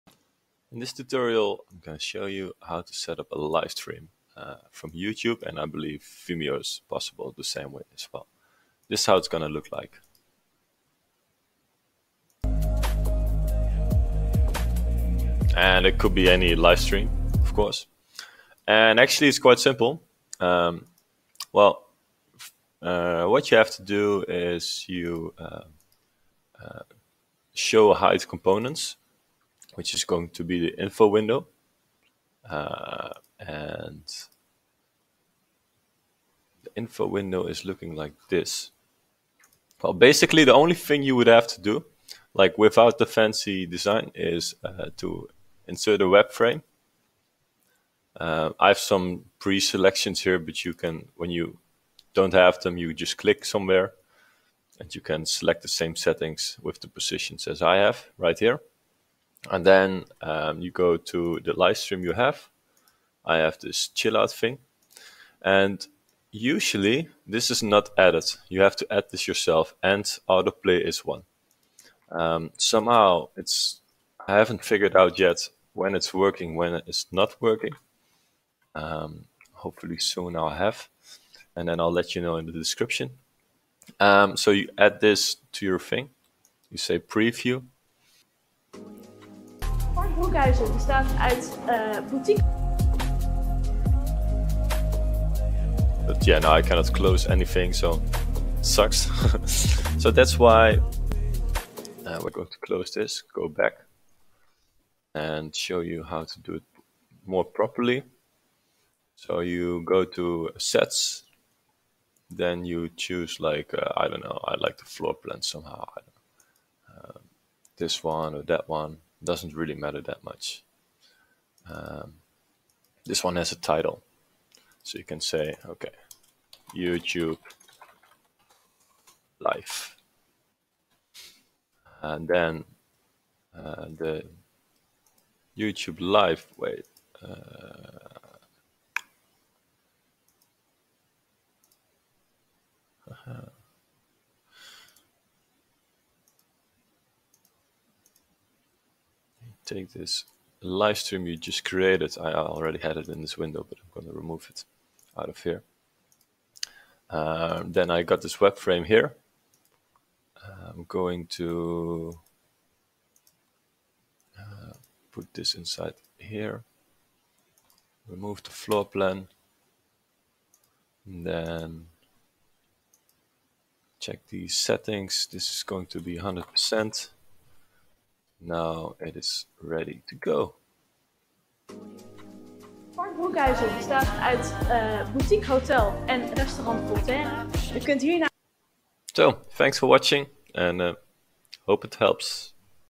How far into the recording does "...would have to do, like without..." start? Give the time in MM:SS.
00:41.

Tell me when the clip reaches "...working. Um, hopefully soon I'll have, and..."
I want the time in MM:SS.
01:17.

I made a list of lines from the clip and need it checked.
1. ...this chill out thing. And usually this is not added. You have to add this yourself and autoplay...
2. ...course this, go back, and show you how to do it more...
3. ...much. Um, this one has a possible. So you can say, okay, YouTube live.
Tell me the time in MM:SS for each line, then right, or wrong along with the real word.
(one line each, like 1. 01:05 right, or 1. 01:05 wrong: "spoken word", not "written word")
1. 01:03 right
2. 01:42 wrong: "close", not "course"
3. 02:00 wrong: "title", not "possible".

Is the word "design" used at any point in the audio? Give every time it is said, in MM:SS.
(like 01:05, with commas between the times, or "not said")
00:43.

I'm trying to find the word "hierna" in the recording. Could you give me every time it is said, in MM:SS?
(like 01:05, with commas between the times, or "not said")
03:08.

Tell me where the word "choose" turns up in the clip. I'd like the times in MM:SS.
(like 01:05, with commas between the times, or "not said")
01:52.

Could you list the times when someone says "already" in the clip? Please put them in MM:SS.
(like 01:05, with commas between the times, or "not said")
02:32.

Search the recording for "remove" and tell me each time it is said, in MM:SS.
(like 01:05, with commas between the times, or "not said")
02:34, 02:48.